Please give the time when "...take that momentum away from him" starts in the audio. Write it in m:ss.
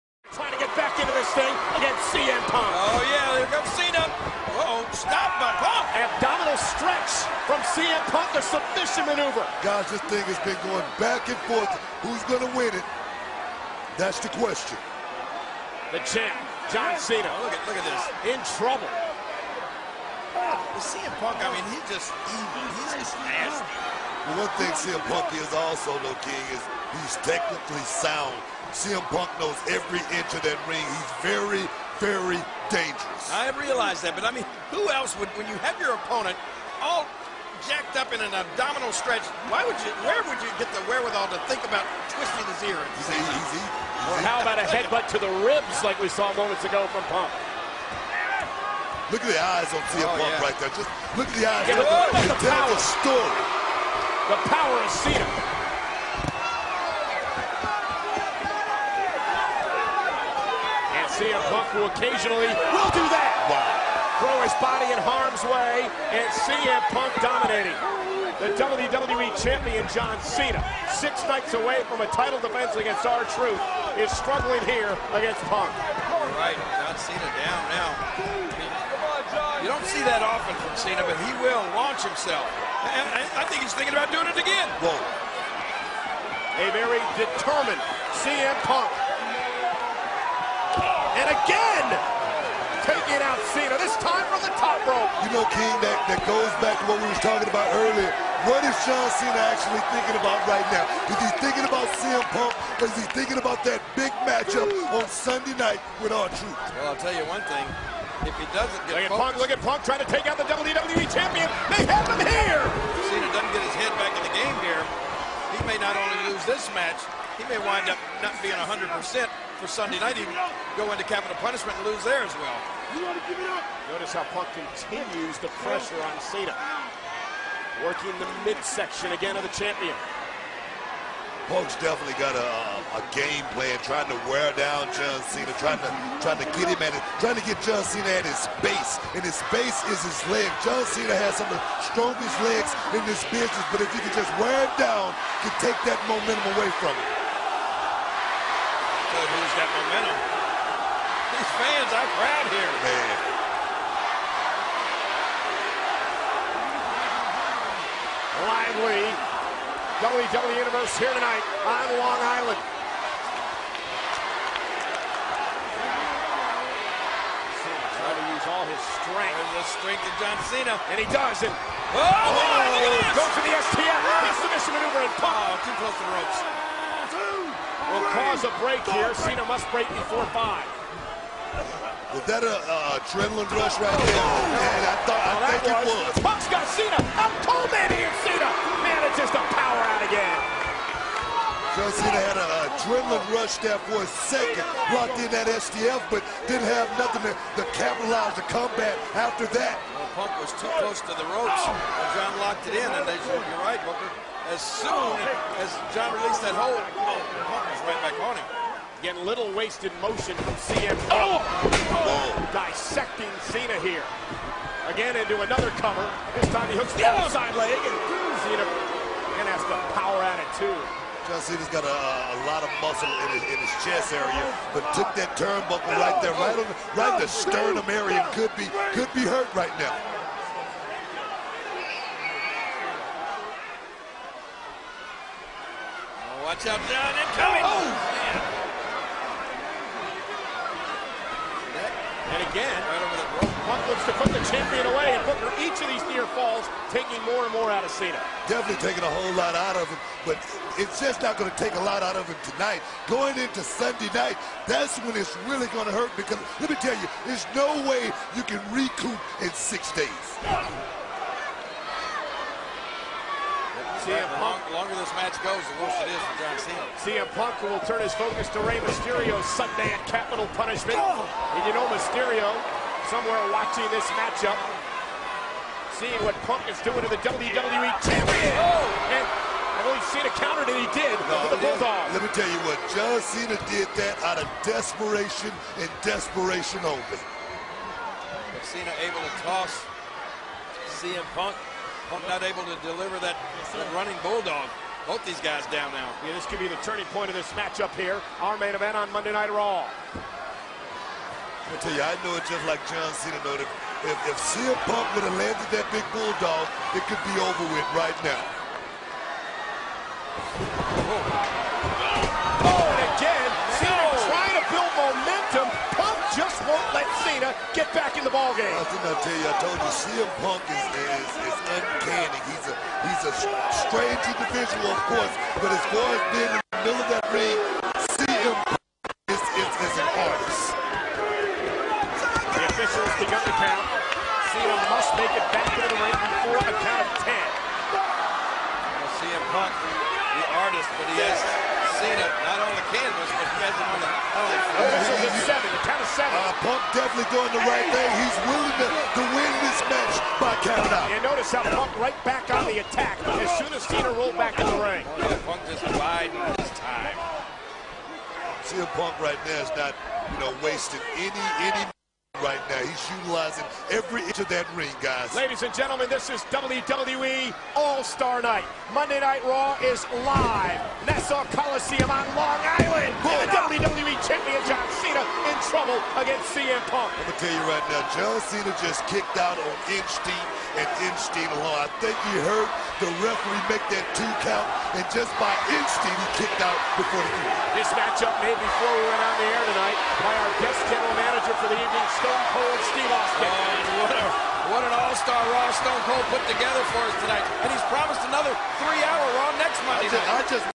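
2:25.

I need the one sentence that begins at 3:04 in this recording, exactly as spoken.
Oh, and I thought, I think was.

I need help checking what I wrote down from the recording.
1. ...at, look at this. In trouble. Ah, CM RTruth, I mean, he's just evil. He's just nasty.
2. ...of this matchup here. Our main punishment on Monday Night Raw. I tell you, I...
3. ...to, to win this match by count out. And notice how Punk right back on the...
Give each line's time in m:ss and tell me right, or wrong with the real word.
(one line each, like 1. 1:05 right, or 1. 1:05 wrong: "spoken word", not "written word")
1. 0:17 wrong: "Punk", not "RTruth"
2. 4:57 wrong: "event", not "punishment"
3. 5:48 right.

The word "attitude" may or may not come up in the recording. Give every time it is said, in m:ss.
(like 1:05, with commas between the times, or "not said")
3:40.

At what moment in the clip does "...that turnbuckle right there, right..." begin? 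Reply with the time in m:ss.
3:45.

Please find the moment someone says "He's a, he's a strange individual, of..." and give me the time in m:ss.
5:22.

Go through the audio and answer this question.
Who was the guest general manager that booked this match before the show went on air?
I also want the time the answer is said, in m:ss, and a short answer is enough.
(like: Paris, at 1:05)
Stone Cold Steve Austin, at 6:32.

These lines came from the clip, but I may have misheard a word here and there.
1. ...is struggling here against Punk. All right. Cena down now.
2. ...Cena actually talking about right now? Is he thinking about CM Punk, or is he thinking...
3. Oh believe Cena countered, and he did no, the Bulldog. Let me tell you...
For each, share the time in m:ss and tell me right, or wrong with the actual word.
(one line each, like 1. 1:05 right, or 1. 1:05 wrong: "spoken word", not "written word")
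1. 1:13 right
2. 1:39 wrong: "thinking", not "talking"
3. 4:38 right.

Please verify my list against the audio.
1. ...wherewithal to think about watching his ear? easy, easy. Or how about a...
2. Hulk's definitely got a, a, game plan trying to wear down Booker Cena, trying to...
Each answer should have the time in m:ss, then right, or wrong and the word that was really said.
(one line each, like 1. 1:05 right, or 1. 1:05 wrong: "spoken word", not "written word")
1. 0:40 wrong: "twisting", not "watching"
2. 2:11 wrong: "John", not "Booker".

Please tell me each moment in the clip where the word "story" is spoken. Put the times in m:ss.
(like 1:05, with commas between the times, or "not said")
0:53.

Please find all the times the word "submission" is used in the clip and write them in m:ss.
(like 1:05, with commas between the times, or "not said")
0:08, 2:54.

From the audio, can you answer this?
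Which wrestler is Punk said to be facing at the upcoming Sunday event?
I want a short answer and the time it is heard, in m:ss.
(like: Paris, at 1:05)
Rey Mysterio, at 4:28.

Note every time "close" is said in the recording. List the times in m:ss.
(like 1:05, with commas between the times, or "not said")
2:55, 3:20.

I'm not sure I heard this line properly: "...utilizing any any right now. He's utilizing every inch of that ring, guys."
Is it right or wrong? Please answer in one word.
wrong.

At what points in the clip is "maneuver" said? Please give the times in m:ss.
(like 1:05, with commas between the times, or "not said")
0:09, 2:54.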